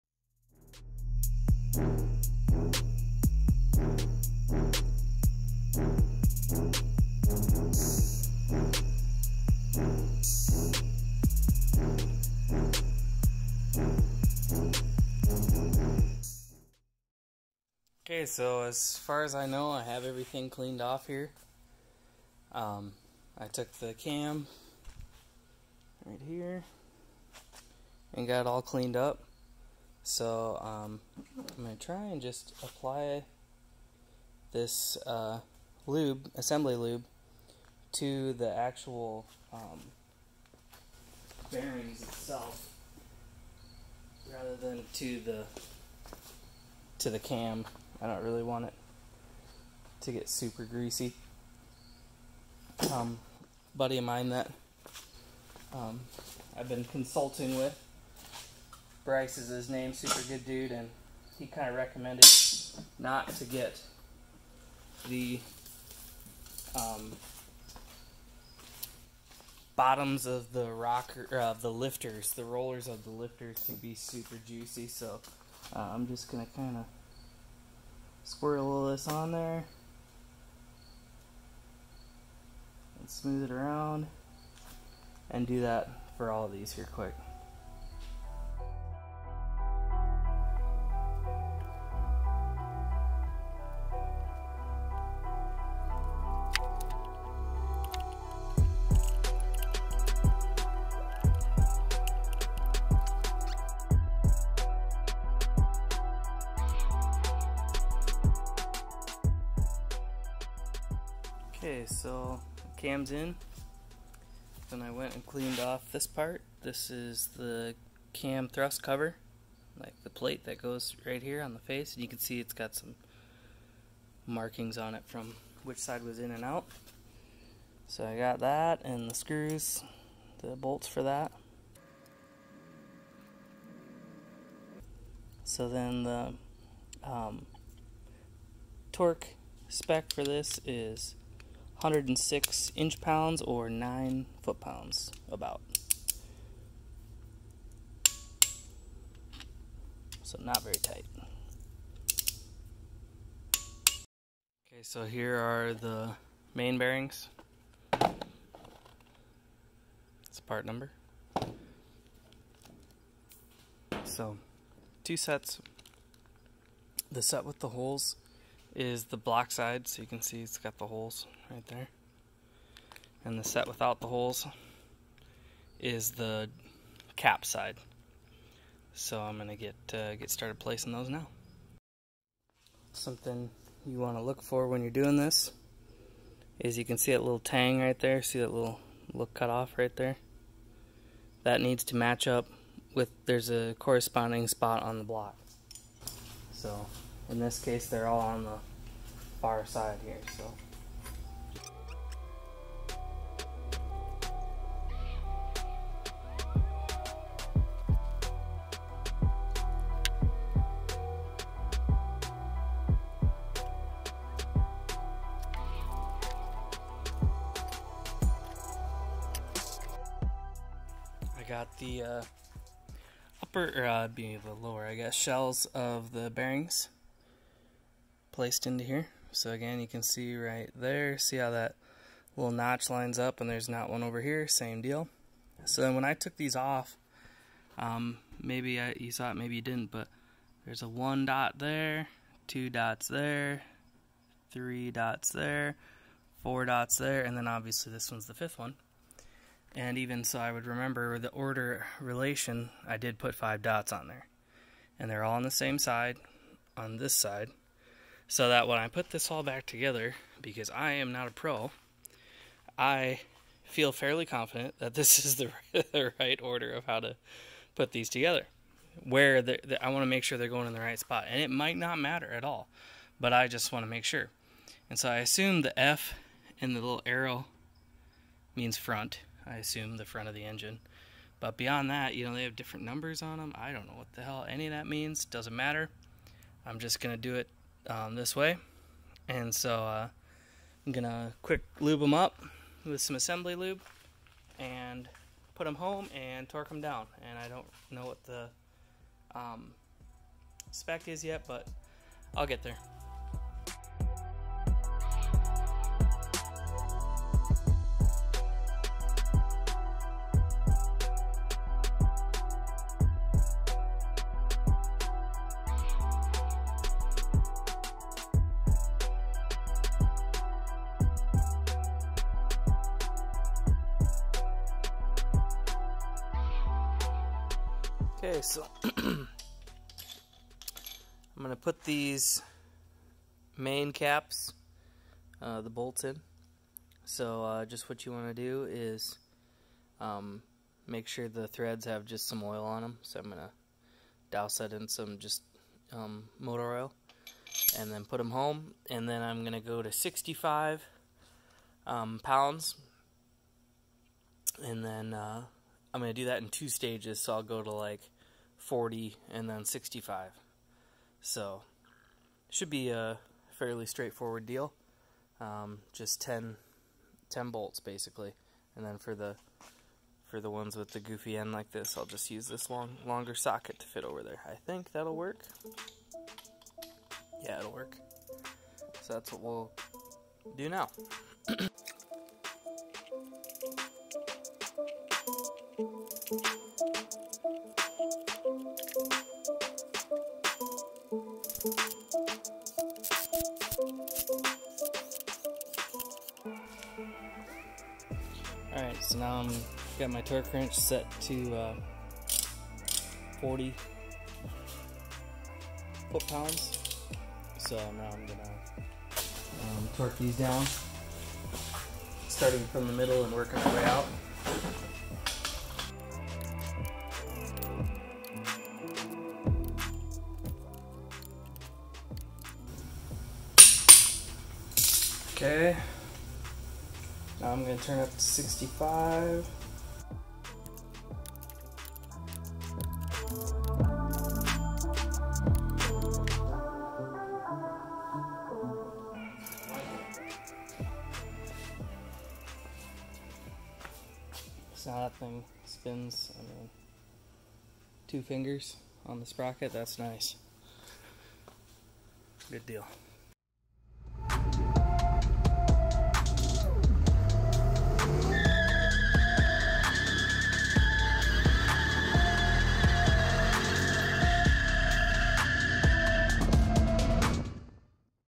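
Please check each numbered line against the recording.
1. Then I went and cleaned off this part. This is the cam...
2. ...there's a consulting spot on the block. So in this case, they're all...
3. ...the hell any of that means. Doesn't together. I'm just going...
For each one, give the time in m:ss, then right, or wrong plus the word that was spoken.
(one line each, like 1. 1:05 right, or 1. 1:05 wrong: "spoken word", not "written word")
1. 1:54 right
2. 3:13 wrong: "corresponding", not "consulting"
3. 4:44 wrong: "matter", not "together".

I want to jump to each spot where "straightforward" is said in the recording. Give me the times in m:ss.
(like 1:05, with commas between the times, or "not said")
6:03.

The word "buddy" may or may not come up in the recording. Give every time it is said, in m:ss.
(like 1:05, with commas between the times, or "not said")
0:53.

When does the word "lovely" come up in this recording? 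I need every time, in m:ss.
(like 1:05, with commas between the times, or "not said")
not said.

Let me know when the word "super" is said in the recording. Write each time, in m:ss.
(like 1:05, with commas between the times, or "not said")
0:50, 0:59, 1:13.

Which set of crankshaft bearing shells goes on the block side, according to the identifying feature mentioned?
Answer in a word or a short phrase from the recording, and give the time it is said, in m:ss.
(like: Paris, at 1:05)
The set with the holes, at 2:47.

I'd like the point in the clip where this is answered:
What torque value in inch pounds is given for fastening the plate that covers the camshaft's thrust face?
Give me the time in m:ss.
2:21.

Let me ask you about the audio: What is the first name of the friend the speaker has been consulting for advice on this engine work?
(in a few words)
Bryce.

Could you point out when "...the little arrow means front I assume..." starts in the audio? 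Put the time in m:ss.
4:36.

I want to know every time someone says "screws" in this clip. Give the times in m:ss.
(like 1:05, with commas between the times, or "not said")
2:09.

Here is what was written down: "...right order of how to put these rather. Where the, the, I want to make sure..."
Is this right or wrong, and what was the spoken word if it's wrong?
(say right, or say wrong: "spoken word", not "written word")
wrong: "together", not "rather".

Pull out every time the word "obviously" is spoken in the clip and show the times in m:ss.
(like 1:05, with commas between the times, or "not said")
4:07.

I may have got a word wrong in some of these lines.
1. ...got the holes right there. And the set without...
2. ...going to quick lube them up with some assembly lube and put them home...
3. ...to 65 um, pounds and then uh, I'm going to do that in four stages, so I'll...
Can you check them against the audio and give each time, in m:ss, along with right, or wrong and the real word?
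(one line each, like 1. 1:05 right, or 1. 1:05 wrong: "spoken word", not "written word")
1. 2:50 right
2. 4:50 right
3. 5:49 wrong: "two", not "four".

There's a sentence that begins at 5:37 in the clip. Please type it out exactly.
So uh, just what you want to do is um, make sure the threads have just some oil on them.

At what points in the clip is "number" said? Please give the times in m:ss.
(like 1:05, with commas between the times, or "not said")
2:40, 4:42.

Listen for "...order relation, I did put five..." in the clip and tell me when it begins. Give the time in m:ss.
4:11.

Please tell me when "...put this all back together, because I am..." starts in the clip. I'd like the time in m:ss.
4:18.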